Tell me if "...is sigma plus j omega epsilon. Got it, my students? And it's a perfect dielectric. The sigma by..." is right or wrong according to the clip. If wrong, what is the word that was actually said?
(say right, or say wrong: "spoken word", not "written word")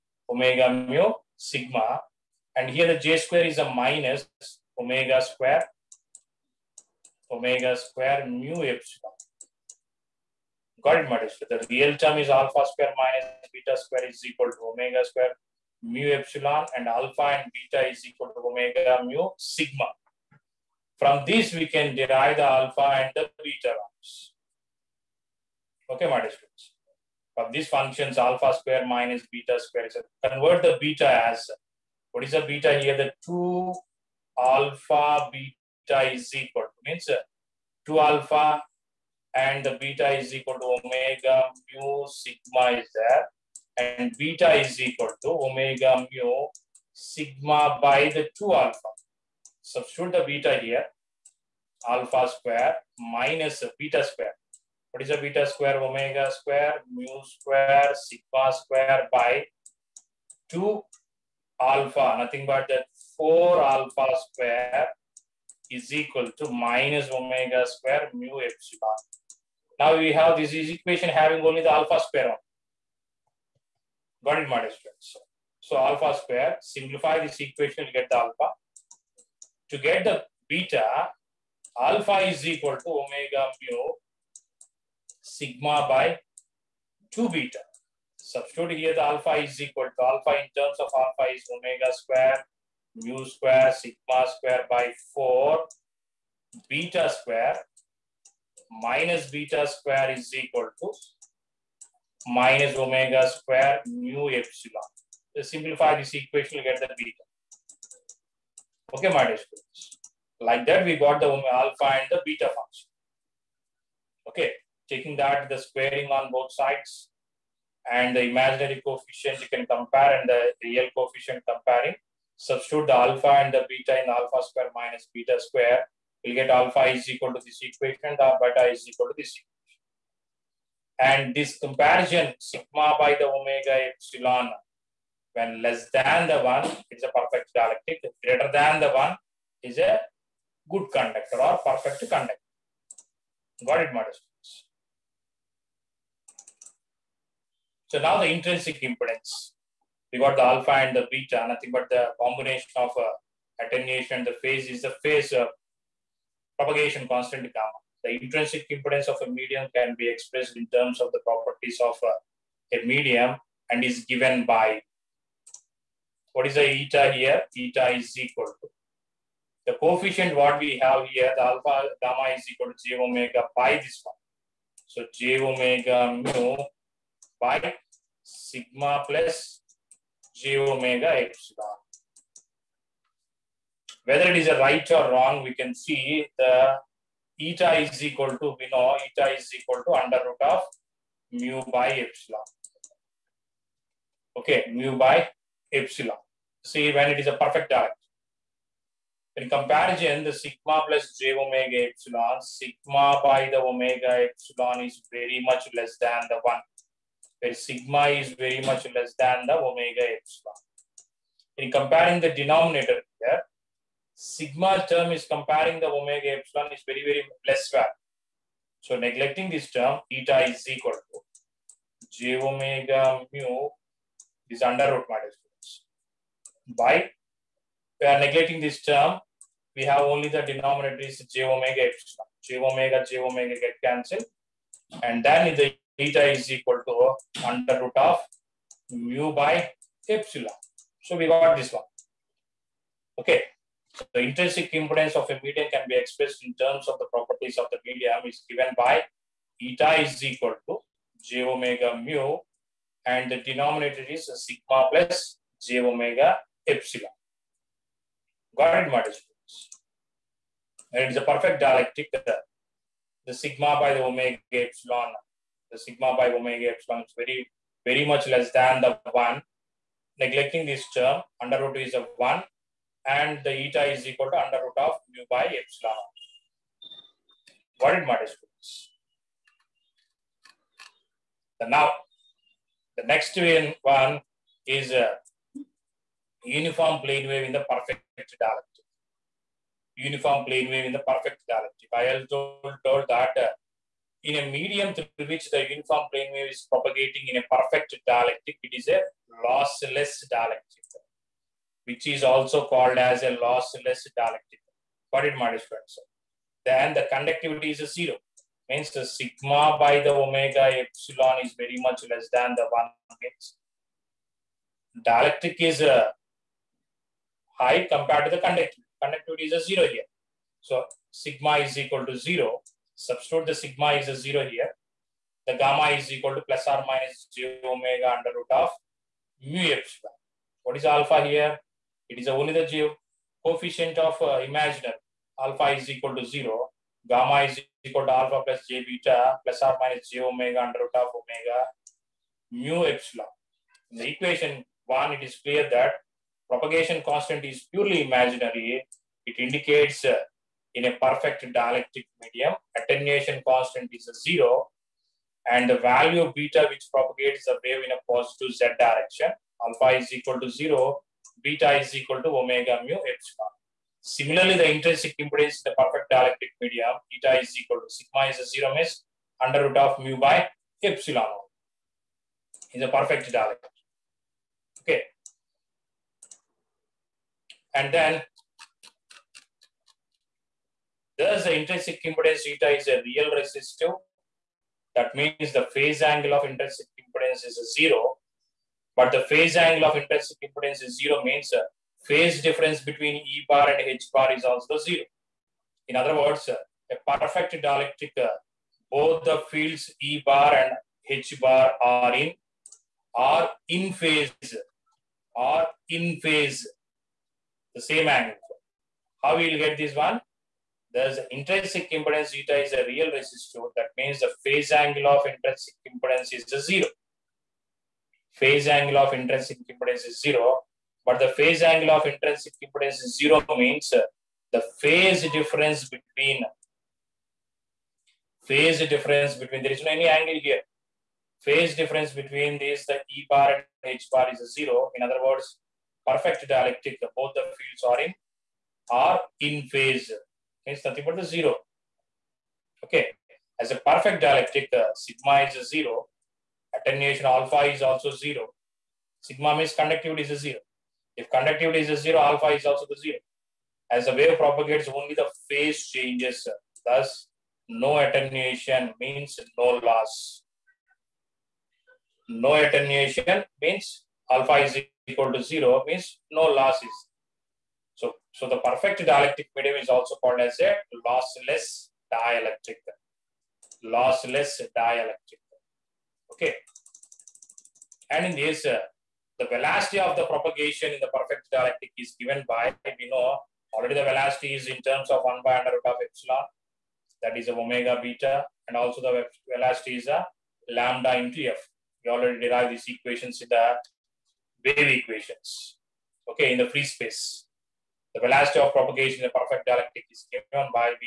right.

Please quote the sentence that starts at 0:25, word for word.
Okay, my From these functions, alpha square minus beta square is convert the beta as what is the beta here?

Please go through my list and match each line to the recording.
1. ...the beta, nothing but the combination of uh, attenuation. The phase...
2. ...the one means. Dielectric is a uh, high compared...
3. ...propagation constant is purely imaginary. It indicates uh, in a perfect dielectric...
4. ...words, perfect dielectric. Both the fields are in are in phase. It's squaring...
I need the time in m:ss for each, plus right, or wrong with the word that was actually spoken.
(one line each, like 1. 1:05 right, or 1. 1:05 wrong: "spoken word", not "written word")
1. 2:30 right
2. 5:12 right
3. 5:46 right
4. 7:15 wrong: "nothing", not "squaring".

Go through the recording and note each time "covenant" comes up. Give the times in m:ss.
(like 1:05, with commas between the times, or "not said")
not said.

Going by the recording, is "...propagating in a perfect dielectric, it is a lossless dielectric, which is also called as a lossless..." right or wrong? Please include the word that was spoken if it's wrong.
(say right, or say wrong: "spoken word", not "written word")
right.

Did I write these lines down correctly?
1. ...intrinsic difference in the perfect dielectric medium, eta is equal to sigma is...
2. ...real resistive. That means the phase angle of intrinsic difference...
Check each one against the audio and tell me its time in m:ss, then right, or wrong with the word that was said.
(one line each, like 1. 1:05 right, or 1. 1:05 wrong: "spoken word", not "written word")
1. 6:04 wrong: "impedance", not "difference"
2. 6:23 wrong: "impedance", not "difference".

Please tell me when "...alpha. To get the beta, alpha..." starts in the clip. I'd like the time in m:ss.
1:18.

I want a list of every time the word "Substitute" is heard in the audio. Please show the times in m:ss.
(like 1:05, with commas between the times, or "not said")
0:49, 1:28, 2:02, 5:23.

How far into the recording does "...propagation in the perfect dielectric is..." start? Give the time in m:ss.
8:00.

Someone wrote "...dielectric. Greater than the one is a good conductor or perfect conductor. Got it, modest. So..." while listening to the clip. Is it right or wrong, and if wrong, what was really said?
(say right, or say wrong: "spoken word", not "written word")
right.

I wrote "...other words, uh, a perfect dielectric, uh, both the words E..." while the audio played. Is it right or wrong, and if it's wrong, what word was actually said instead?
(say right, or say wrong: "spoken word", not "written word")
wrong: "fields", not "words".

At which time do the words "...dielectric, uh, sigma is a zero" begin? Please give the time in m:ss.
7:24.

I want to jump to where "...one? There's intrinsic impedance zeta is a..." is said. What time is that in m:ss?
6:49.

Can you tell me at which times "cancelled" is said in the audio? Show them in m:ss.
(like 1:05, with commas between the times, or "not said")
3:53.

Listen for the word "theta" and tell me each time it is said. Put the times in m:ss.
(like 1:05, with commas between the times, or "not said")
3:55.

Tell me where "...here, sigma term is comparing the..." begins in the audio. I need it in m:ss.
3:33.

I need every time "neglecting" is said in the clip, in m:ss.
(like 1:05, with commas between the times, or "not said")
3:38, 3:48, 4:30.